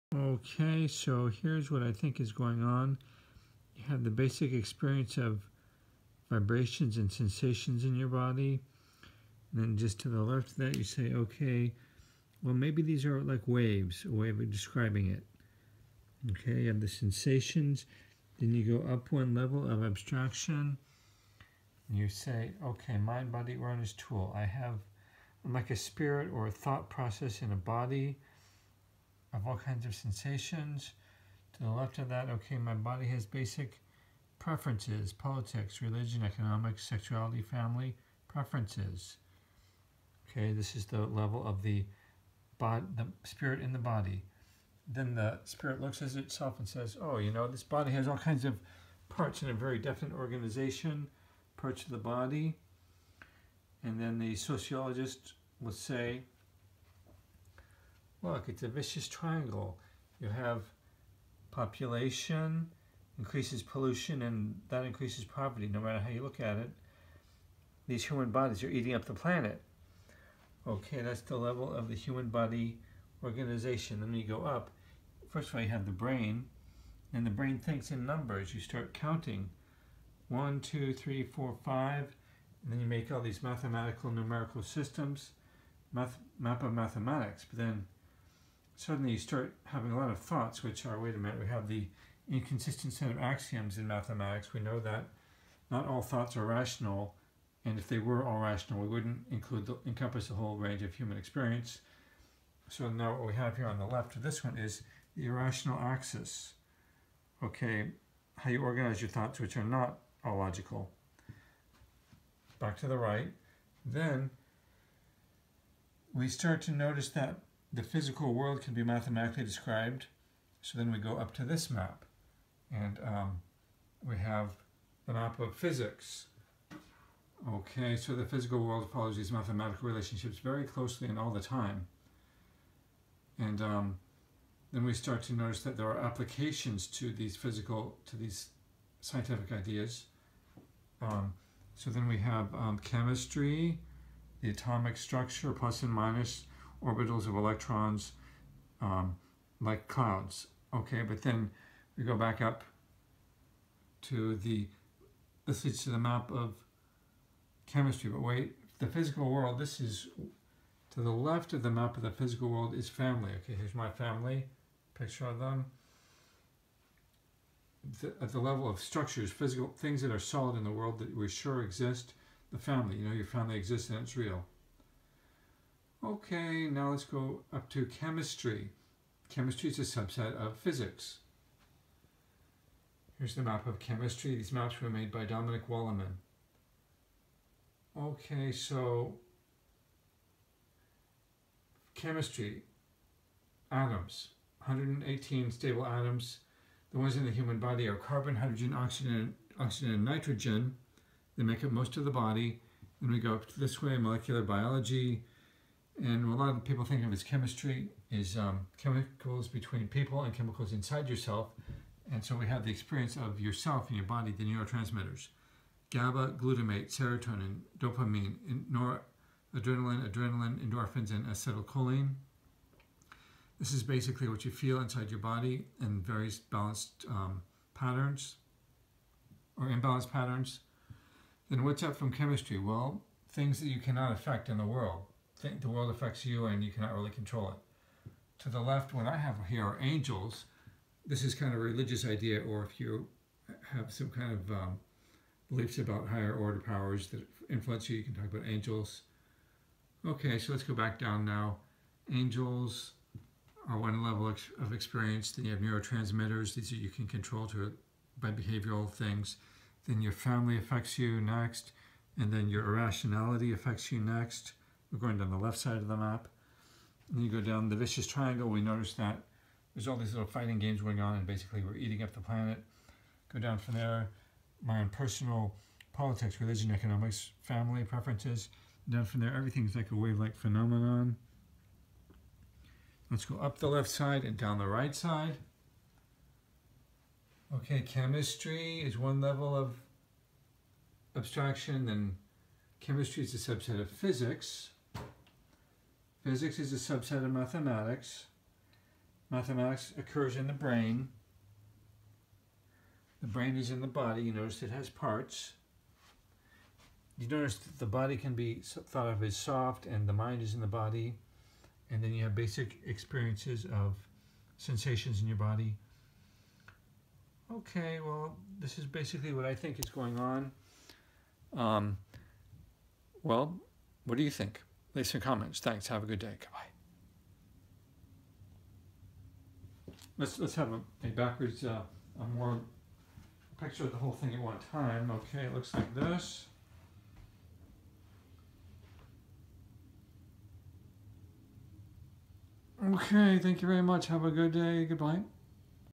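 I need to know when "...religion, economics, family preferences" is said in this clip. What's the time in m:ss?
4:36.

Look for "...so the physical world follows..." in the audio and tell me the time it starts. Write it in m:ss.
2:07.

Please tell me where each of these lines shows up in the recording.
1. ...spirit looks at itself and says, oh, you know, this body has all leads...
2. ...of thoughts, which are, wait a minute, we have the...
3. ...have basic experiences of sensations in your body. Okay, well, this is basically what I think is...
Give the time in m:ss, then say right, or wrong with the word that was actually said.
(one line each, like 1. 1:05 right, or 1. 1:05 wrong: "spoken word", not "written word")
1. 0:45 wrong: "kinds", not "leads"
2. 1:30 right
3. 5:12 right.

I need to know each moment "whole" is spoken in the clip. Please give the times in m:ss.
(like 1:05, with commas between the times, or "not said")
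1:40, 5:33.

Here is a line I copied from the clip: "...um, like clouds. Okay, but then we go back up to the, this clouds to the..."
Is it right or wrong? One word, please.
wrong.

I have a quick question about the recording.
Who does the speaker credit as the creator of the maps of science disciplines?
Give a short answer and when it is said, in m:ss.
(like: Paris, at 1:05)
Dominic Walliman, at 3:05.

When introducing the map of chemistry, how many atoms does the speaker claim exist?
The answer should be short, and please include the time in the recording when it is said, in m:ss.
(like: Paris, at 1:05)
118, at 3:14.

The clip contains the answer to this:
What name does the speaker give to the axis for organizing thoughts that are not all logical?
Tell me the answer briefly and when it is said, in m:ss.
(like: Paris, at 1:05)
Irrational axis, at 1:45.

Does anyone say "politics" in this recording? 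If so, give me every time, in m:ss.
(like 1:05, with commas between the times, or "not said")
0:35, 4:35.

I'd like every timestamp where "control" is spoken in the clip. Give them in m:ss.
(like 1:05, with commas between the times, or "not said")
3:57, 4:17.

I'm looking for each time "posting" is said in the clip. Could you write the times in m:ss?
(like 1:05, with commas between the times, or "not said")
not said.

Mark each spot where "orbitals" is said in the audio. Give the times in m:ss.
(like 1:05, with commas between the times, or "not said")
2:26.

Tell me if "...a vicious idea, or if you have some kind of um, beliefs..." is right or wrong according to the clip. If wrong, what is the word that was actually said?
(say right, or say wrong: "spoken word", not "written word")
wrong: "religious", not "vicious".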